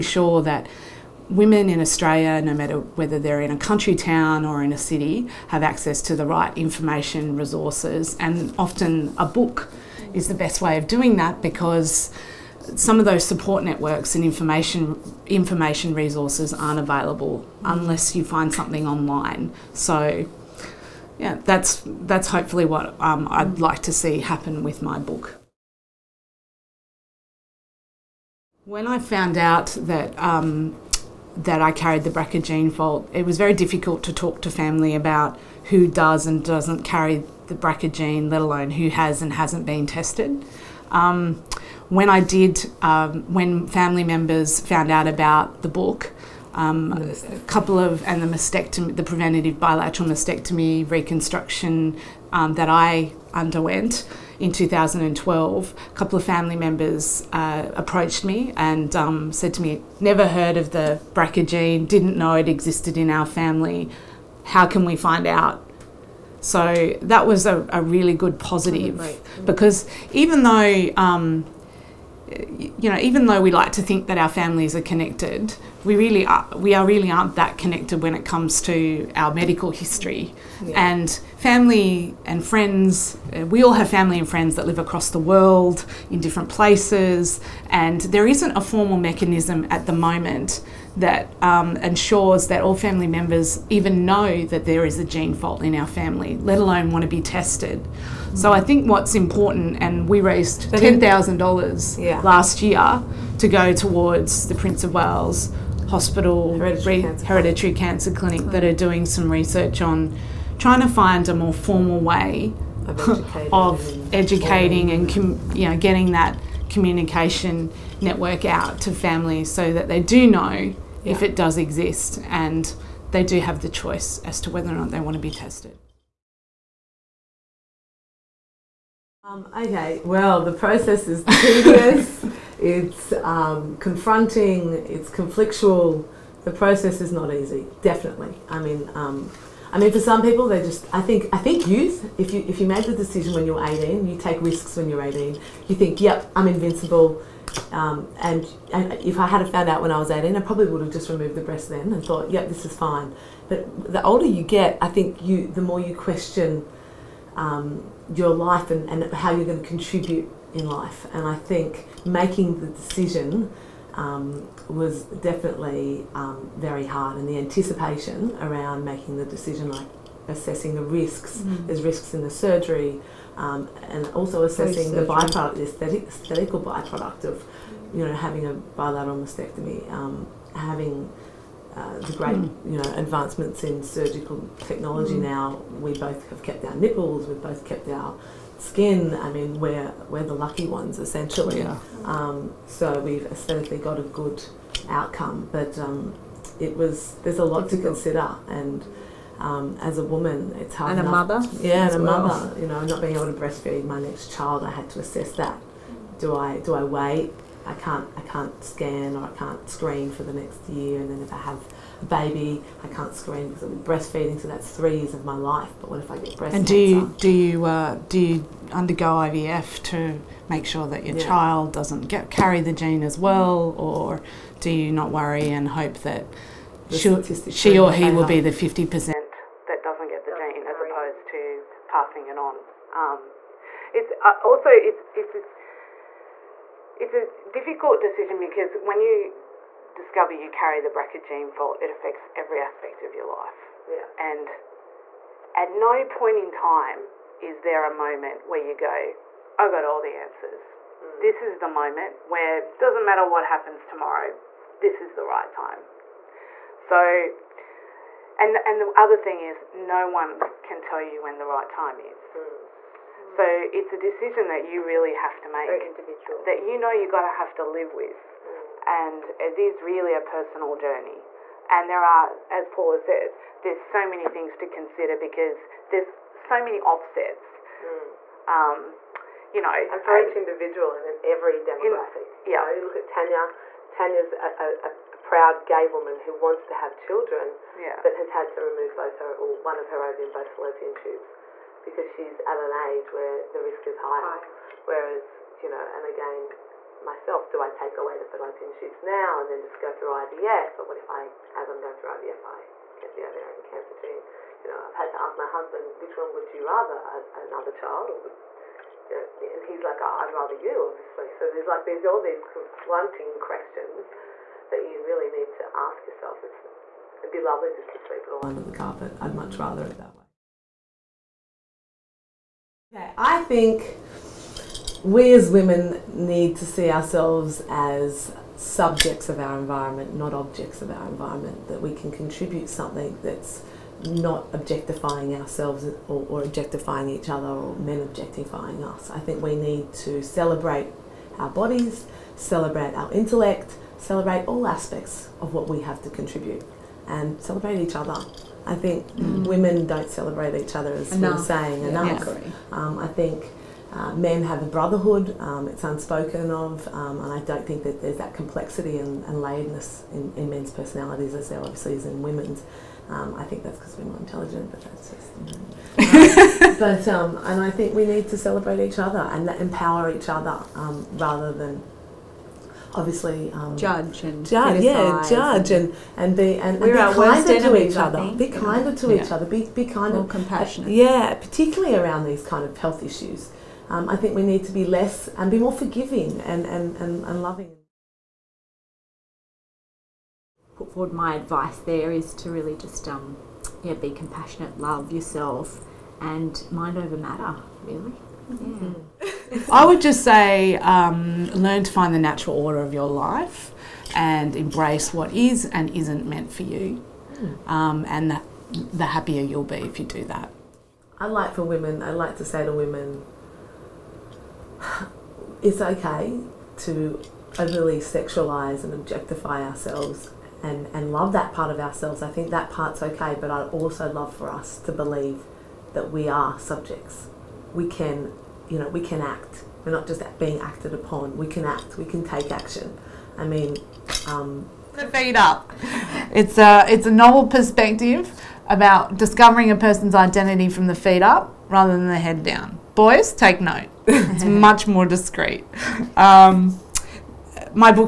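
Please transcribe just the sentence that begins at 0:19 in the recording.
So yeah, that's that's hopefully what um, I'd like to see happen with my book.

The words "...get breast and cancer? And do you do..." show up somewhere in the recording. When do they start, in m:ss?
3:36.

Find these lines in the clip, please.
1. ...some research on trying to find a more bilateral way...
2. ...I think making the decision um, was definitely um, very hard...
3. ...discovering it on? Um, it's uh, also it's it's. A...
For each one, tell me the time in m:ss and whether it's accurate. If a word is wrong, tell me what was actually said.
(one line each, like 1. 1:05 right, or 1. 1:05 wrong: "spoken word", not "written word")
1. 1:49 wrong: "formal", not "bilateral"
2. 2:41 right
3. 3:51 wrong: "passing", not "discovering".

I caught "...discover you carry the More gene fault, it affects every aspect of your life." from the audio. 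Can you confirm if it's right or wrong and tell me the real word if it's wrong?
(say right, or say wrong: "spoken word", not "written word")
wrong: "BRCA", not "More".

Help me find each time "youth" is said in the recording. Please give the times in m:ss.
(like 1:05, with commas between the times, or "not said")
2:21.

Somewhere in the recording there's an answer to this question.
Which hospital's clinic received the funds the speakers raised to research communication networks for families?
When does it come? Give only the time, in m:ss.
1:44.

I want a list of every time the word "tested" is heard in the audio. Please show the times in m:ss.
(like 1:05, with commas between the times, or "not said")
0:39, 1:37, 2:05.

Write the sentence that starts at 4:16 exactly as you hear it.
So and and the other thing is no one can tell you when the right time is.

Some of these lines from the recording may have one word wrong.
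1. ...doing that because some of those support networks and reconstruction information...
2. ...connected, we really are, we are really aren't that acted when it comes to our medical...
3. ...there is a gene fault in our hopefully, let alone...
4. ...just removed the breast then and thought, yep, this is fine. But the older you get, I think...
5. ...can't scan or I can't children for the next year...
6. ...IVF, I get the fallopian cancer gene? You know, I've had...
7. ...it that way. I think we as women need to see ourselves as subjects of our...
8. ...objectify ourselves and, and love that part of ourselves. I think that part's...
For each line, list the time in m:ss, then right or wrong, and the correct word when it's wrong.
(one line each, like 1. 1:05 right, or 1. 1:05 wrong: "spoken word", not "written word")
1. 0:10 wrong: "information", not "reconstruction"
2. 1:14 wrong: "connected", not "acted"
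3. 1:34 wrong: "family", not "hopefully"
4. 2:30 right
5. 3:28 wrong: "screen", not "children"
6. 5:02 wrong: "ovarian", not "fallopian"
7. 5:19 right
8. 6:58 right.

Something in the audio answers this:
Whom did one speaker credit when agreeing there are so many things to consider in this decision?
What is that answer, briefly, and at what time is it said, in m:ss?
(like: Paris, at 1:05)
Paula, at 4:32.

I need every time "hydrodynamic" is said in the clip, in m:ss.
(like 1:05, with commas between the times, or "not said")
not said.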